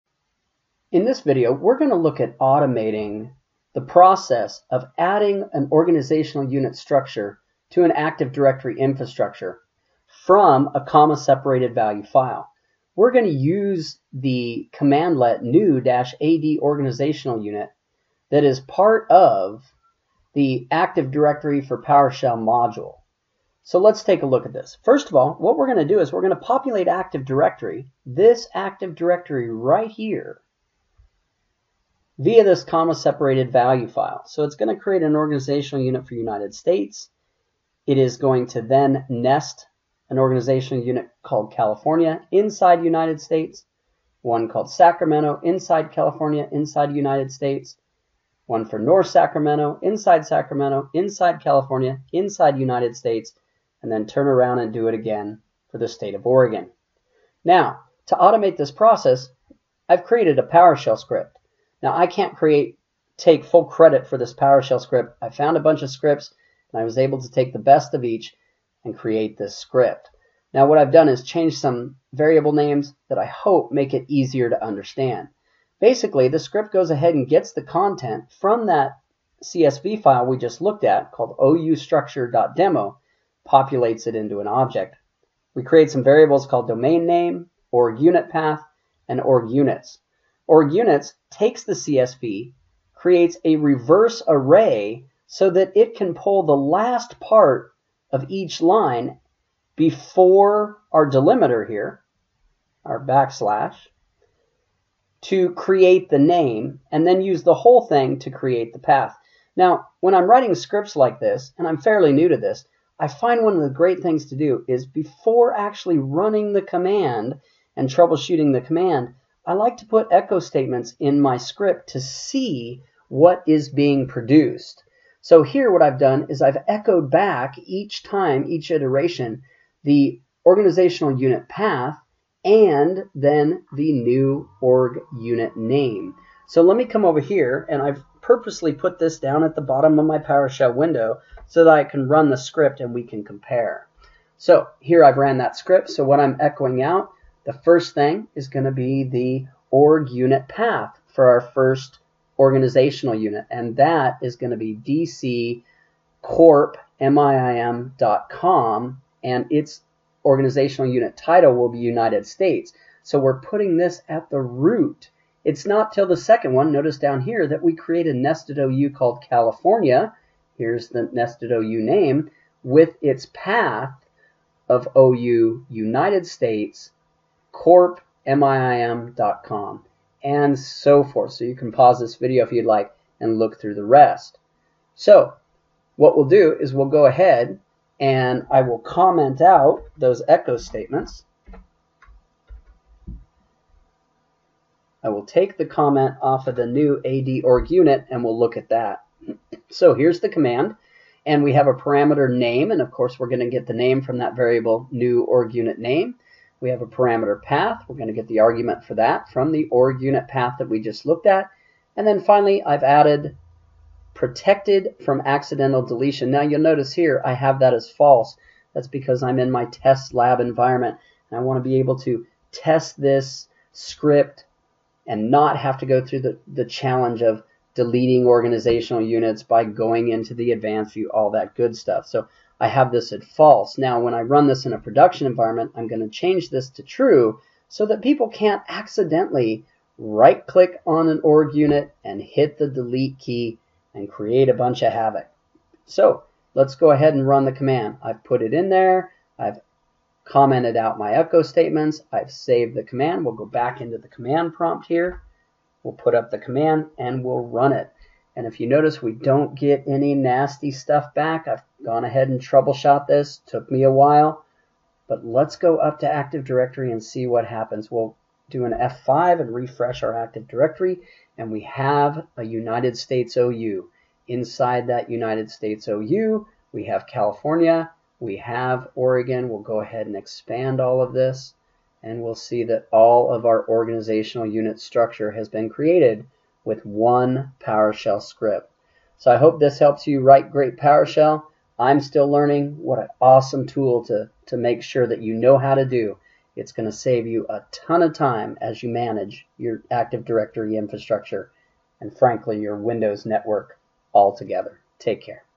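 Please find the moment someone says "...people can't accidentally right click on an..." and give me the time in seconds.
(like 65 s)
238 s.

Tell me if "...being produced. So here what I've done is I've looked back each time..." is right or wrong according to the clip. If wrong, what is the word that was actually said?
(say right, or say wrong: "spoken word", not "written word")
wrong: "echoed", not "looked".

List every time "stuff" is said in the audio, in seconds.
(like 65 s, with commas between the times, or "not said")
231 s, 260 s.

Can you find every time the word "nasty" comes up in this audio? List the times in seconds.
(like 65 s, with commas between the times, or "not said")
260 s.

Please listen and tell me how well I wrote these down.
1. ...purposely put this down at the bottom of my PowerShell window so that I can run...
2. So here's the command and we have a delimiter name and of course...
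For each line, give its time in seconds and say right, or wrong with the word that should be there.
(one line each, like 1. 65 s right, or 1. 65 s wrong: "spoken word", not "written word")
1. 138 s right
2. 199 s wrong: "parameter", not "delimiter".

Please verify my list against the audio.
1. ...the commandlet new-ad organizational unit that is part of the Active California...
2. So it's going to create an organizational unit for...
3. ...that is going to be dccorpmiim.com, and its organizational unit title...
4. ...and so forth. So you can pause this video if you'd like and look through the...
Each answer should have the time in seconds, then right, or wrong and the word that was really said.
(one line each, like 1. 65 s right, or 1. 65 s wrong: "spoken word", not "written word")
1. 14 s wrong: "Directory", not "California"
2. 34 s right
3. 153 s right
4. 180 s right.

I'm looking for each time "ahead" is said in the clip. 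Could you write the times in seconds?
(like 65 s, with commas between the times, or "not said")
76 s, 187 s, 246 s, 262 s, 279 s.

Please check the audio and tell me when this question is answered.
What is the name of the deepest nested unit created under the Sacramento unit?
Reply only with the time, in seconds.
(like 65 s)
48 s.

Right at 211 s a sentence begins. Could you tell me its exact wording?
And then finally, I've added protected from accidental deletion.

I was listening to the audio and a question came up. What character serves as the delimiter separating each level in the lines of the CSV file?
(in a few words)
backslash.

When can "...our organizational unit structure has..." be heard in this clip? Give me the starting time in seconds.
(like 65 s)
283 s.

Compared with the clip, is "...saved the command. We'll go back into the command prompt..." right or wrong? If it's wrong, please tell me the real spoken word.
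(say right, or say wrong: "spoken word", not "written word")
right.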